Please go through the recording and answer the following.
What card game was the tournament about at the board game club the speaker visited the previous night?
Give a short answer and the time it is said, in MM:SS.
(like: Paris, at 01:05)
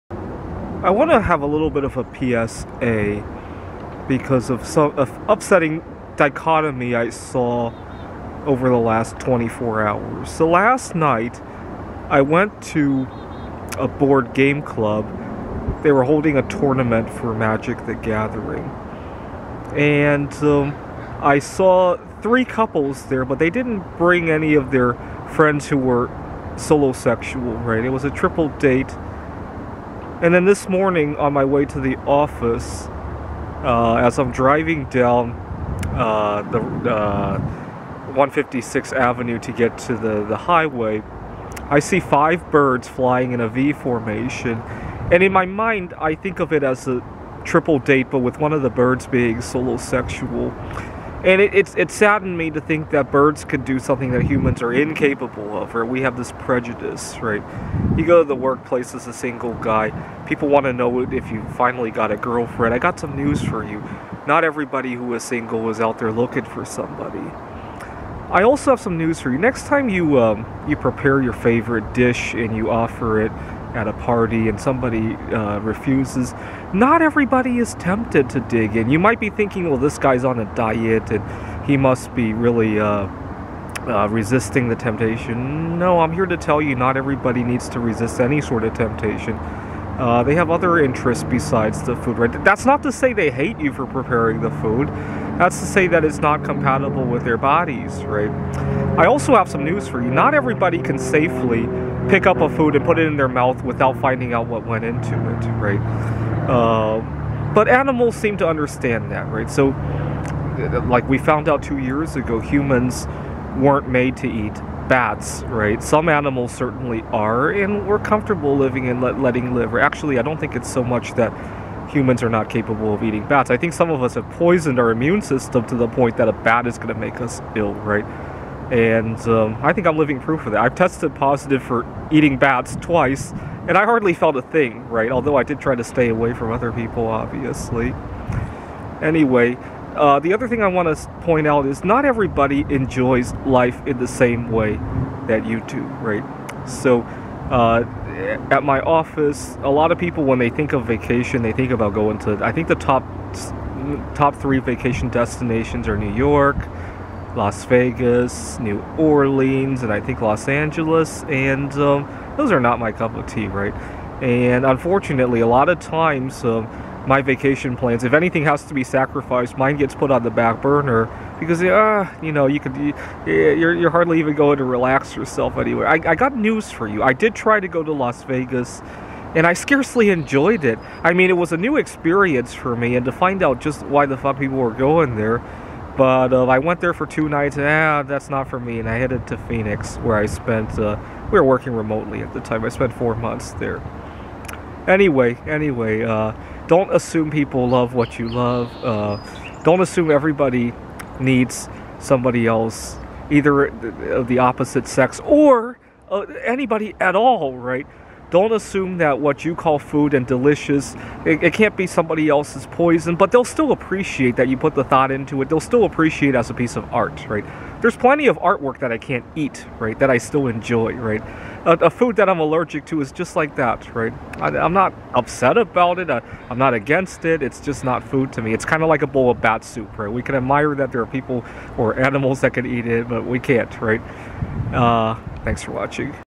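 Magic the Gathering, at 00:17.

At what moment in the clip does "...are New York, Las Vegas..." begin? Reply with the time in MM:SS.
02:35.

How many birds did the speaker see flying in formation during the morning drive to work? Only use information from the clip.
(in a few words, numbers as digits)
5.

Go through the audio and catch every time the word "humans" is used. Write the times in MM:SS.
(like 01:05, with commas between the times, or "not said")
00:54, 01:52, 02:01.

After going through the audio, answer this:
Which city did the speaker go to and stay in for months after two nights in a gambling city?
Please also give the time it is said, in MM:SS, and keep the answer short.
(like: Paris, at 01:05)
Phoenix, at 03:09.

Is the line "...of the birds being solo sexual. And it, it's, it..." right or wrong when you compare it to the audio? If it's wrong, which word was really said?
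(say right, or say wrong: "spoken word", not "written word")
right.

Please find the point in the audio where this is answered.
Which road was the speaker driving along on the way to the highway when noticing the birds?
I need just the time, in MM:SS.
00:38.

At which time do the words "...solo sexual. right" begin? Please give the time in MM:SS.
00:26.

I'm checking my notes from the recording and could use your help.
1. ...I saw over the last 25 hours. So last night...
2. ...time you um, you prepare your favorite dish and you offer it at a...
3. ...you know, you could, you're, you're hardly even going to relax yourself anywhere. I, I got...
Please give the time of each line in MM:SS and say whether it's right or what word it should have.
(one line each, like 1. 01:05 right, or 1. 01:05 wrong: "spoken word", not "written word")
1. 00:06 wrong: "24", not "25"
2. 01:09 right
3. 02:52 right.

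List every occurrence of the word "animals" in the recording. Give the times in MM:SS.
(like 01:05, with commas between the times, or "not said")
01:47, 01:56, 03:51.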